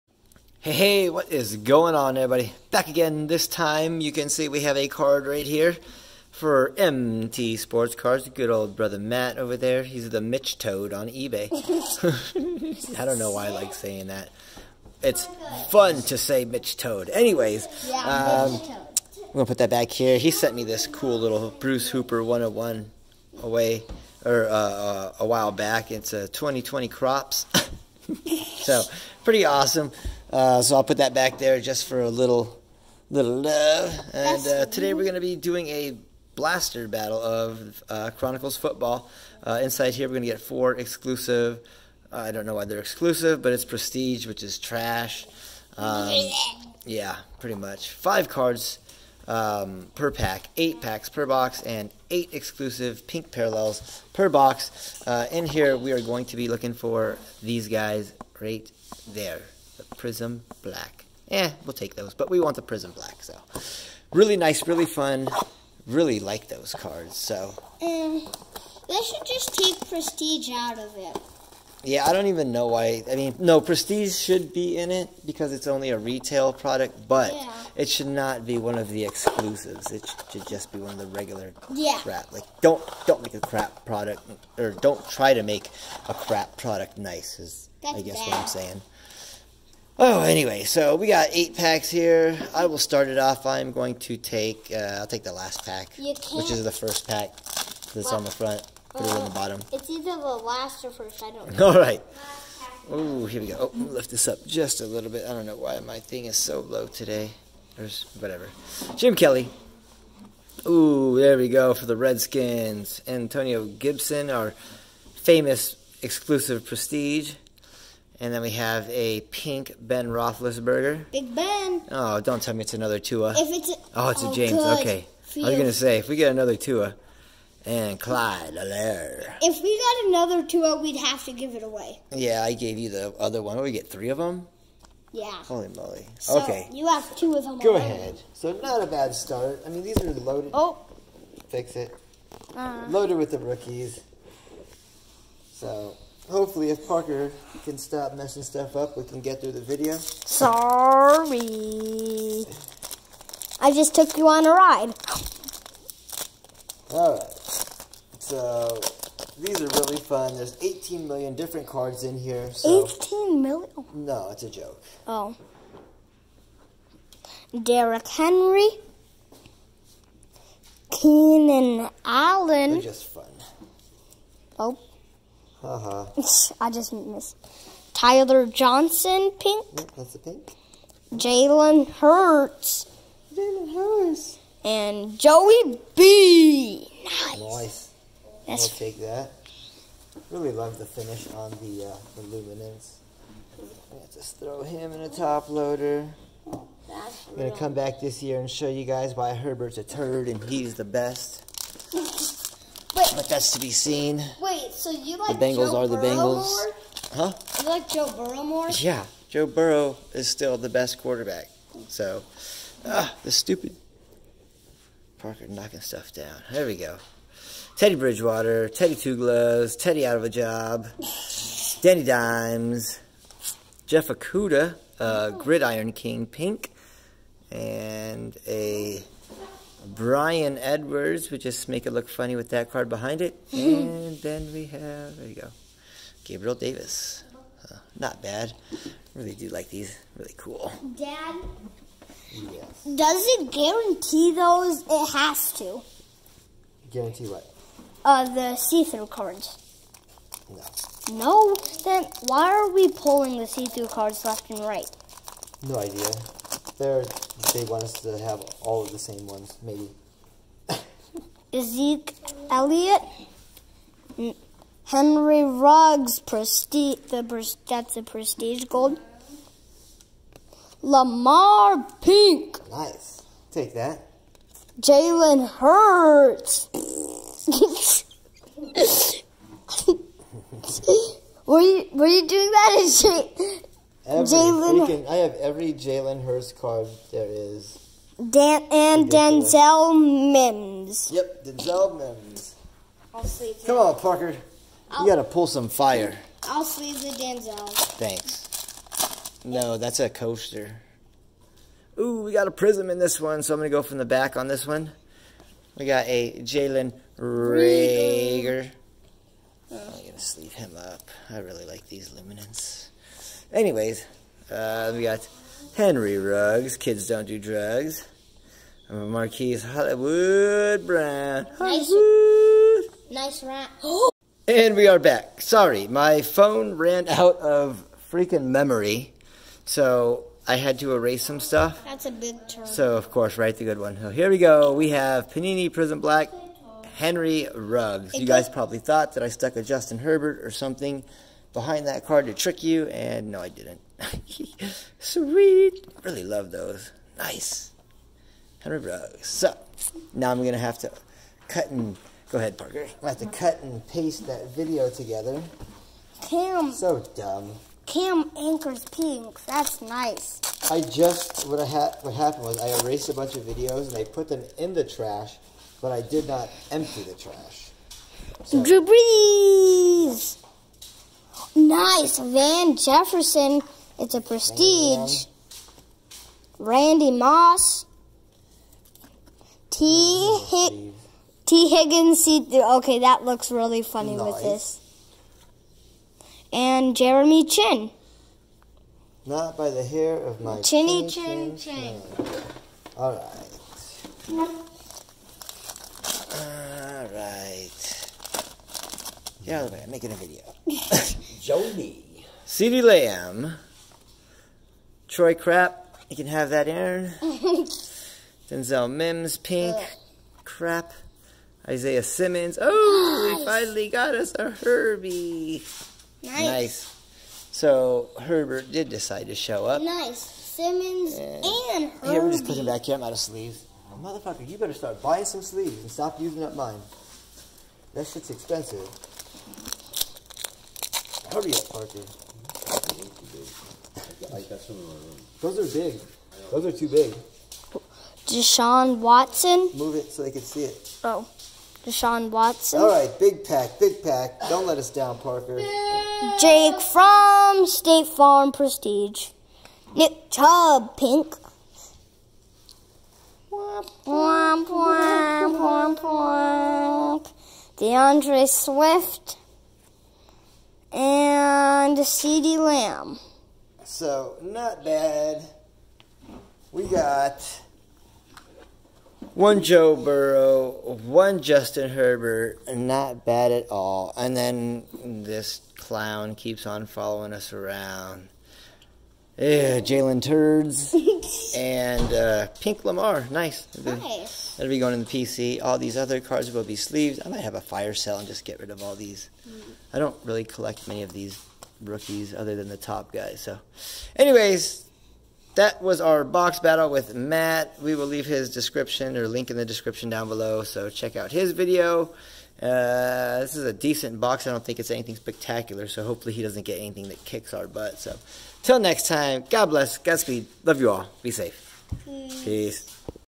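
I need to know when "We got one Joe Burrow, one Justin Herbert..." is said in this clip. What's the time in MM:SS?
07:46.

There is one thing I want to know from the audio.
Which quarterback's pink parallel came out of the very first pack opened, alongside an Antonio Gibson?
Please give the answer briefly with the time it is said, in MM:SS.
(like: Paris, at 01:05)
Ben Roethlisberger, at 01:59.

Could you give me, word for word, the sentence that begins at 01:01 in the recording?
Eh, we'll take those, but we want the Prizm black, so.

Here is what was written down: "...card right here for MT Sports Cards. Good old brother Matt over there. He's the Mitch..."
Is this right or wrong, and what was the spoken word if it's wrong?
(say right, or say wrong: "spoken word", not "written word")
right.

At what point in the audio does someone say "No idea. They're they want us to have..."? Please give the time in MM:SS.
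04:15.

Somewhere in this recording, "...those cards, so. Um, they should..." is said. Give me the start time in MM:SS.
01:06.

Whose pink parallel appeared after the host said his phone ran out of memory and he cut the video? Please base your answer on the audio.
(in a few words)
Cam Akers.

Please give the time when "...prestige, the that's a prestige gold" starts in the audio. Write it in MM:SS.
04:26.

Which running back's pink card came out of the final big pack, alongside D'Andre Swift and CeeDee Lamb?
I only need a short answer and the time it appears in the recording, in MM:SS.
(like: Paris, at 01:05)
Nick Chubb, at 07:29.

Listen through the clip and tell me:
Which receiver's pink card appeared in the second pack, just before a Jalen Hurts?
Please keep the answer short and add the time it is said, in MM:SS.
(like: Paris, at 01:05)
Tyler Johnson, at 02:57.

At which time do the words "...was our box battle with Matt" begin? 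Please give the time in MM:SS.
08:15.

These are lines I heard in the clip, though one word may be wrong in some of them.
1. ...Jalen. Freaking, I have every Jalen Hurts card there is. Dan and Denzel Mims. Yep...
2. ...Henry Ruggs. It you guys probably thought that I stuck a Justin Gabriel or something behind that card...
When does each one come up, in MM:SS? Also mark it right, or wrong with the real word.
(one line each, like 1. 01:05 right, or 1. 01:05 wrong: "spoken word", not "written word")
1. 04:44 right
2. 05:36 wrong: "Herbert", not "Gabriel".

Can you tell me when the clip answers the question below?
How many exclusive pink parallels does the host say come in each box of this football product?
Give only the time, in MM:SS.
00:52.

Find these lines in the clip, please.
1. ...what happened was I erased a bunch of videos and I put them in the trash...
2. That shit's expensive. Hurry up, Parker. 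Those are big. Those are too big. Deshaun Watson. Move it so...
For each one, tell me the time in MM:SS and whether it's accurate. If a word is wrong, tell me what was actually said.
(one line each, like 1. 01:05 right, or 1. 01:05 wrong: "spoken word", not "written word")
1. 06:02 right
2. 07:07 right.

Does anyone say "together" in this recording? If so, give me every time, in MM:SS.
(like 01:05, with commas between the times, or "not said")
05:54.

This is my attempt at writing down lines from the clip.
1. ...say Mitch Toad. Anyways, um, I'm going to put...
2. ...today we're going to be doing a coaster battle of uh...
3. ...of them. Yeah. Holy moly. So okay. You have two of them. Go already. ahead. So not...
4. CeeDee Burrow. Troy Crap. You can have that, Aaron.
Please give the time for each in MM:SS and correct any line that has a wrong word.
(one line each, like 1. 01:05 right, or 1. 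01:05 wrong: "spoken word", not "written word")
1. 00:16 right
2. 00:34 wrong: "blaster", not "coaster"
3. 02:14 right
4. 06:42 wrong: "Lamb", not "Burrow".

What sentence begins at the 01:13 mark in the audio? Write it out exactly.
I mean, no, Prestige should be in it because it's only a retail product, but yeah.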